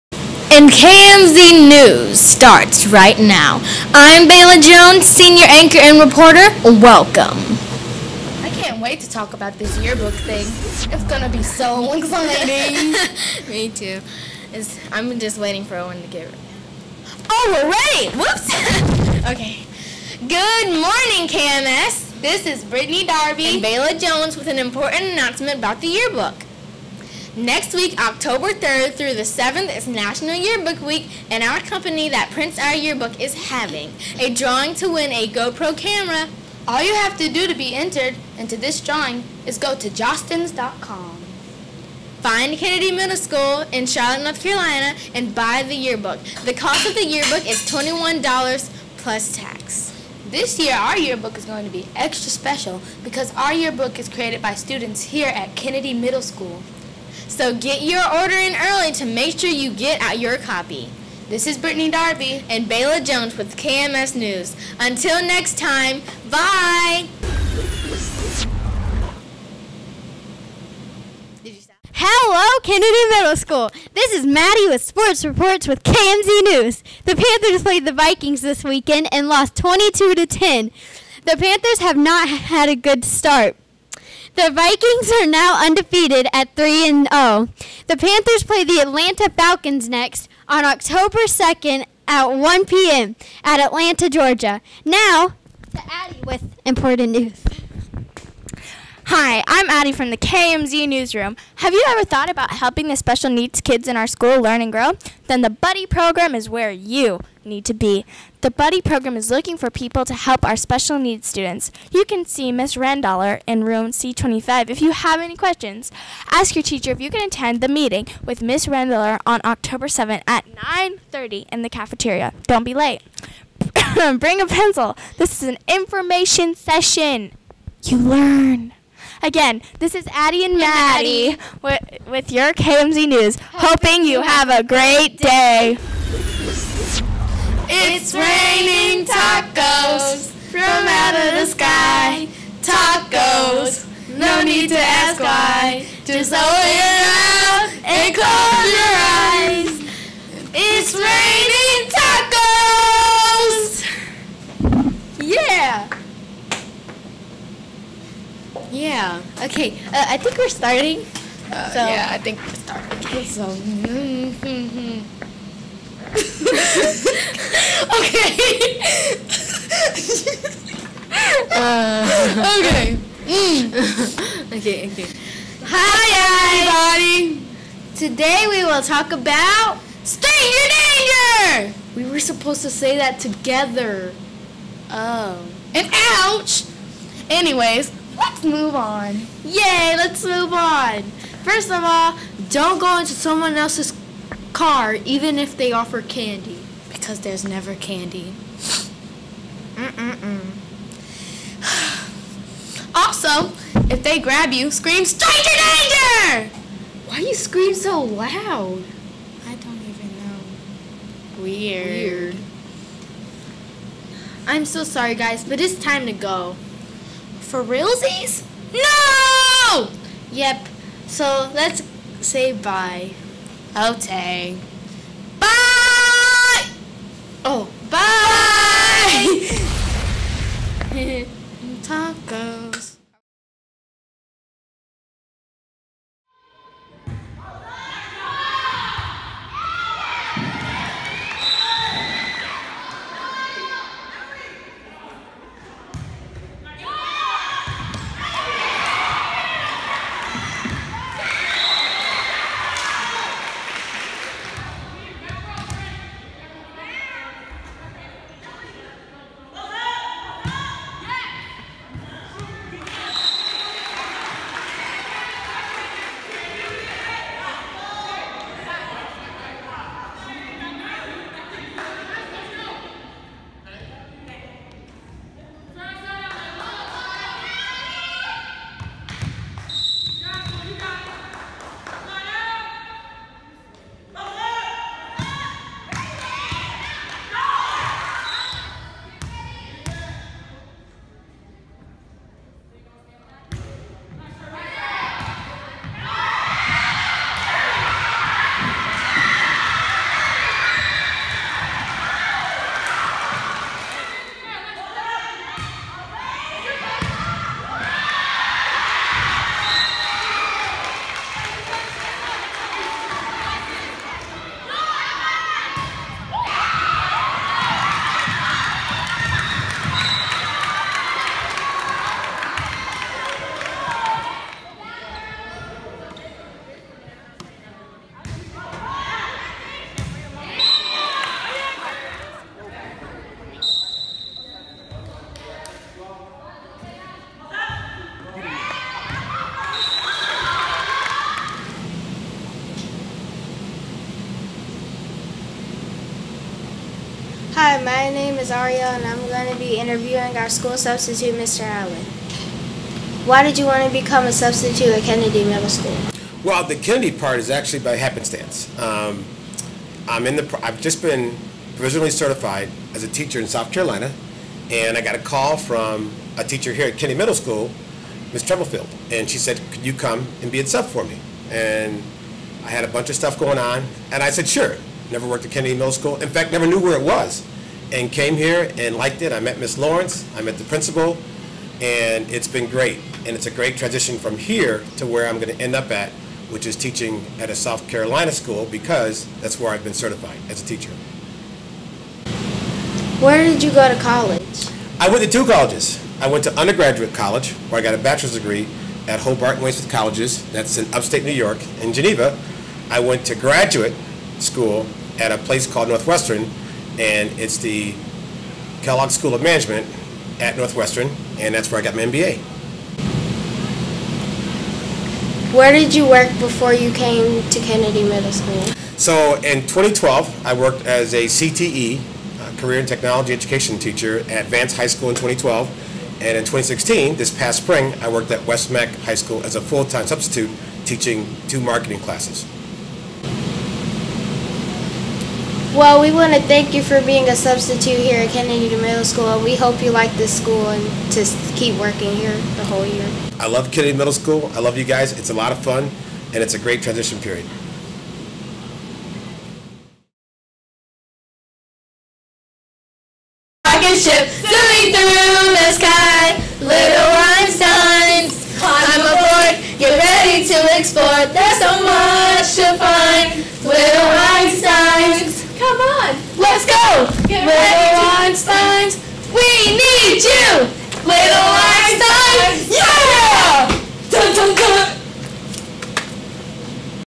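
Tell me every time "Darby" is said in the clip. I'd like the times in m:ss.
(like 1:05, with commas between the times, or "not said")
0:23, 1:01.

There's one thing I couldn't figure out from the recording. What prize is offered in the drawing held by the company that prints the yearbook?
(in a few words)
GoPro camera.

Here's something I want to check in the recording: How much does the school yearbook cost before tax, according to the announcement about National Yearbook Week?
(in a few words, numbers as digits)
$21.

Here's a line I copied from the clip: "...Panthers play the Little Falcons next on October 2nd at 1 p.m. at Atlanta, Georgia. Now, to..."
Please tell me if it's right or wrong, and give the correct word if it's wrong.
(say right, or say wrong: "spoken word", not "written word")
wrong: "Atlanta", not "Little".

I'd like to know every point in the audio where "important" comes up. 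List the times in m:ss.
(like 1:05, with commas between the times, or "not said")
0:24, 1:36.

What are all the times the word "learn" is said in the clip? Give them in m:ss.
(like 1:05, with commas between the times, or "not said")
1:44, 2:07.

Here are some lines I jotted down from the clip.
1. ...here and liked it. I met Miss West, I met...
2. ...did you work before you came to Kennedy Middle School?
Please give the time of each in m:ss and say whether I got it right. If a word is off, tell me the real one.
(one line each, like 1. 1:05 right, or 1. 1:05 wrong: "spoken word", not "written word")
1. 6:18 wrong: "Lawrence", not "West"
2. 6:55 right.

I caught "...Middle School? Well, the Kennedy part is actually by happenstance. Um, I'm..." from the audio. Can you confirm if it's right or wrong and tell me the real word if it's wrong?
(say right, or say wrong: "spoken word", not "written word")
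right.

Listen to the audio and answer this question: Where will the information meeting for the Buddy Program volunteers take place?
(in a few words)
the cafeteria.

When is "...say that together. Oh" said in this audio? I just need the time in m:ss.
3:02.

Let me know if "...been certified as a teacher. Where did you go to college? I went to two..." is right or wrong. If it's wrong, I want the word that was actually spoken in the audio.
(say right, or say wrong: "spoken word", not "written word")
right.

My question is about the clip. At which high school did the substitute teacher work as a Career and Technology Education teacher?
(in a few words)
Vance High School.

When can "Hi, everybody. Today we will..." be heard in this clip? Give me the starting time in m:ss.
2:55.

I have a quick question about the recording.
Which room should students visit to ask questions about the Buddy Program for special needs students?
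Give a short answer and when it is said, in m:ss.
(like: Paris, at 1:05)
C25, at 1:53.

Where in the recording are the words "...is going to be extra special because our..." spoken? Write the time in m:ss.
0:51.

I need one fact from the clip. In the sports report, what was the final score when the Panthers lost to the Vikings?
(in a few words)
22 to 10.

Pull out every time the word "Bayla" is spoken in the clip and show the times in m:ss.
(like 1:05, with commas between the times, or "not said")
0:04, 0:23, 1:02.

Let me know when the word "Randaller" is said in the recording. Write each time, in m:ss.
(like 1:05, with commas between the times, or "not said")
1:52, 1:58.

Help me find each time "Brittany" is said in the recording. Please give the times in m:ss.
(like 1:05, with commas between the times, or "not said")
0:22, 1:01.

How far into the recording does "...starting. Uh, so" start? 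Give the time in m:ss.
2:40.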